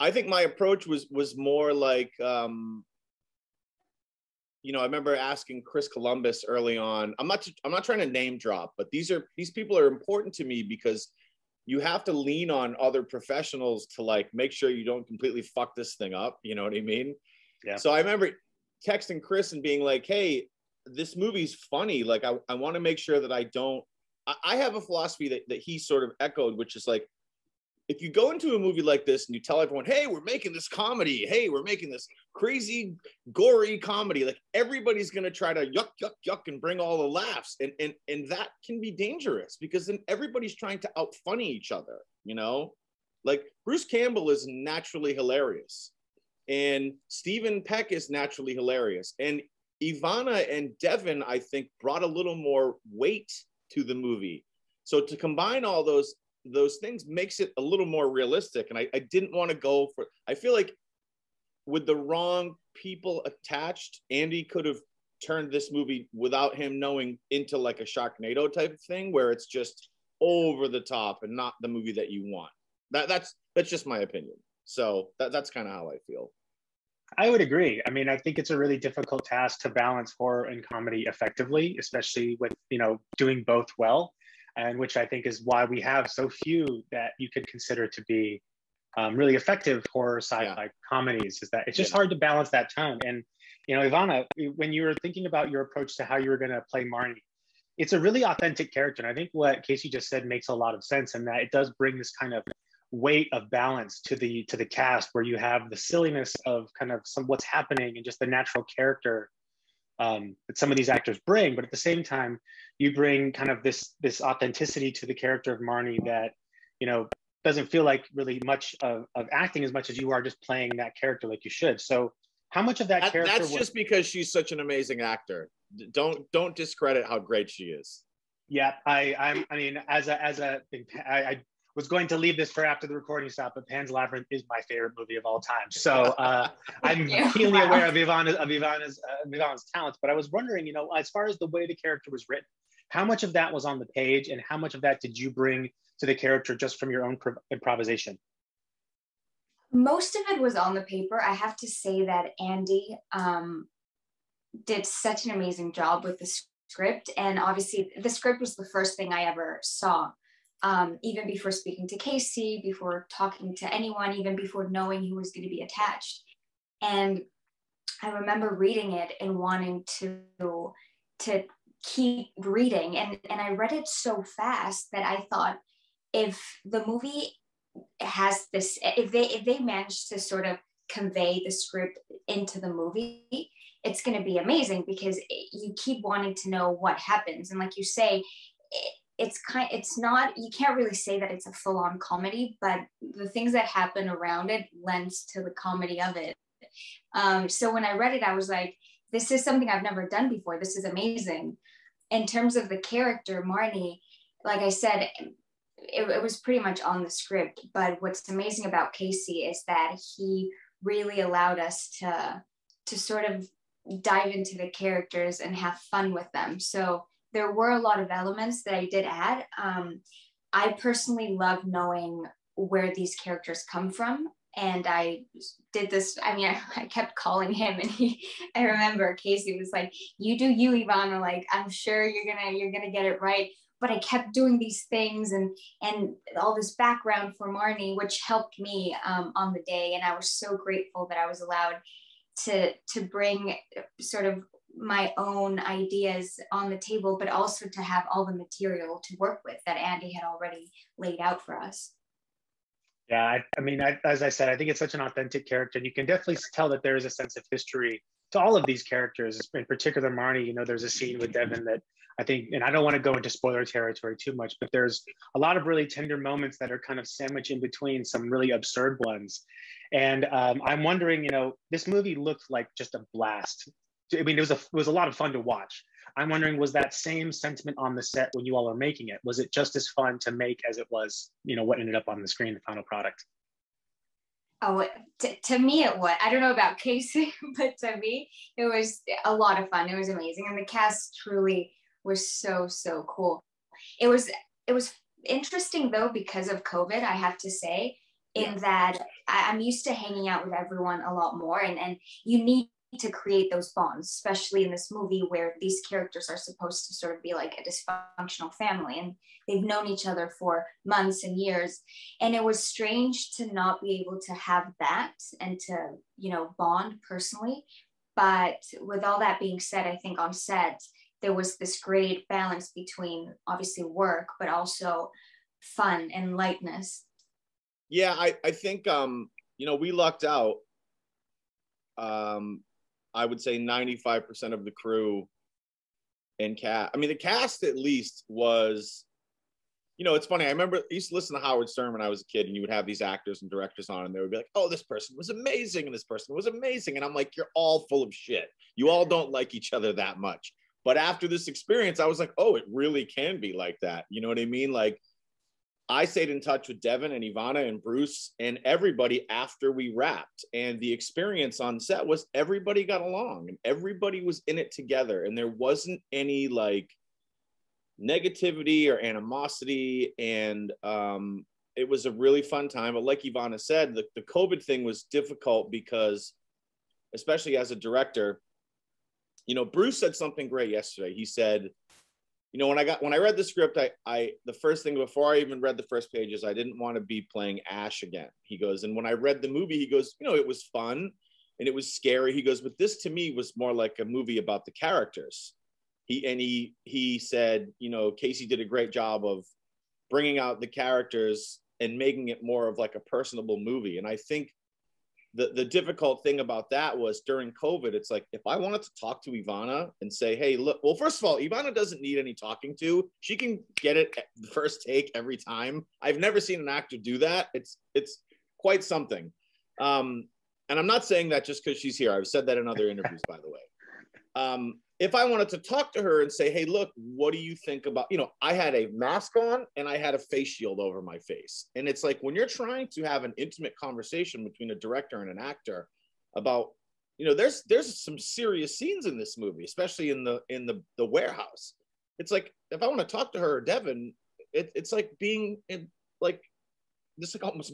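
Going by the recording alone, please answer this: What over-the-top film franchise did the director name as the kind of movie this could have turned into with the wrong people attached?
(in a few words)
Sharknado.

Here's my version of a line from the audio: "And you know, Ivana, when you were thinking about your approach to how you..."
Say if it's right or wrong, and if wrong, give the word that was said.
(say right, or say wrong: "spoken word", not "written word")
right.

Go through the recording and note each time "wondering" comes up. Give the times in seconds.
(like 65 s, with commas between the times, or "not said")
140 s, 270 s, 276 s.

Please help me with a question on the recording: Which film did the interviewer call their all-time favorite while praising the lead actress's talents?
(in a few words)
Pan's Labyrinth.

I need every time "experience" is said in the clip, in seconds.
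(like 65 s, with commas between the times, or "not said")
351 s, 360 s.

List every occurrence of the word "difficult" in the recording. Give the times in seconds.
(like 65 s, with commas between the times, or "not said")
78 s, 375 s, 405 s.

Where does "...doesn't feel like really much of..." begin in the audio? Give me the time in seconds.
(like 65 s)
117 s.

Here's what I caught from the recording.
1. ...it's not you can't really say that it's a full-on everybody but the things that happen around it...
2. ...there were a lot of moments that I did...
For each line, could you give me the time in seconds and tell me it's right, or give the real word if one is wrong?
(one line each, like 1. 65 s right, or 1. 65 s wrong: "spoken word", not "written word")
1. 189 s wrong: "comedy", not "everybody"
2. 217 s wrong: "elements", not "moments".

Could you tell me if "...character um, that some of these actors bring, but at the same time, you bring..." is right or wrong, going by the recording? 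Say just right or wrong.
right.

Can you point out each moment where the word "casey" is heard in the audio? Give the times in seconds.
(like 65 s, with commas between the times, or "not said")
99 s, 161 s, 208 s, 229 s, 286 s, 398 s.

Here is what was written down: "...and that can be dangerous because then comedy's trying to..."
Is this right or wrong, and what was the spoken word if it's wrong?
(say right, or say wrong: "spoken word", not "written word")
wrong: "everybody", not "comedy".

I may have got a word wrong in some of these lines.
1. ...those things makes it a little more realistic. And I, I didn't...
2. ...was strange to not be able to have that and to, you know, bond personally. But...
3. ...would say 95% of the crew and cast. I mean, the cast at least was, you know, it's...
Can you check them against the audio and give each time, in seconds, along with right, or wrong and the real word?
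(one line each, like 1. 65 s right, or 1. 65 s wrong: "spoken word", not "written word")
1. 56 s right
2. 312 s right
3. 333 s right.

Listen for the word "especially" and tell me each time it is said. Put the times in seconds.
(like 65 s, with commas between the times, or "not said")
81 s, 304 s, 377 s, 439 s.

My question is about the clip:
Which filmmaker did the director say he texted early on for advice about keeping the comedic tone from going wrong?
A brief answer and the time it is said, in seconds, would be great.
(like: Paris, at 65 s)
Chris Columbus, at 5 s.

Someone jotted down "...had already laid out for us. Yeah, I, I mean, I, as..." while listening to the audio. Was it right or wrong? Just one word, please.
right.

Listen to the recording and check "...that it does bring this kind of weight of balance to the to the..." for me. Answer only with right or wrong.
right.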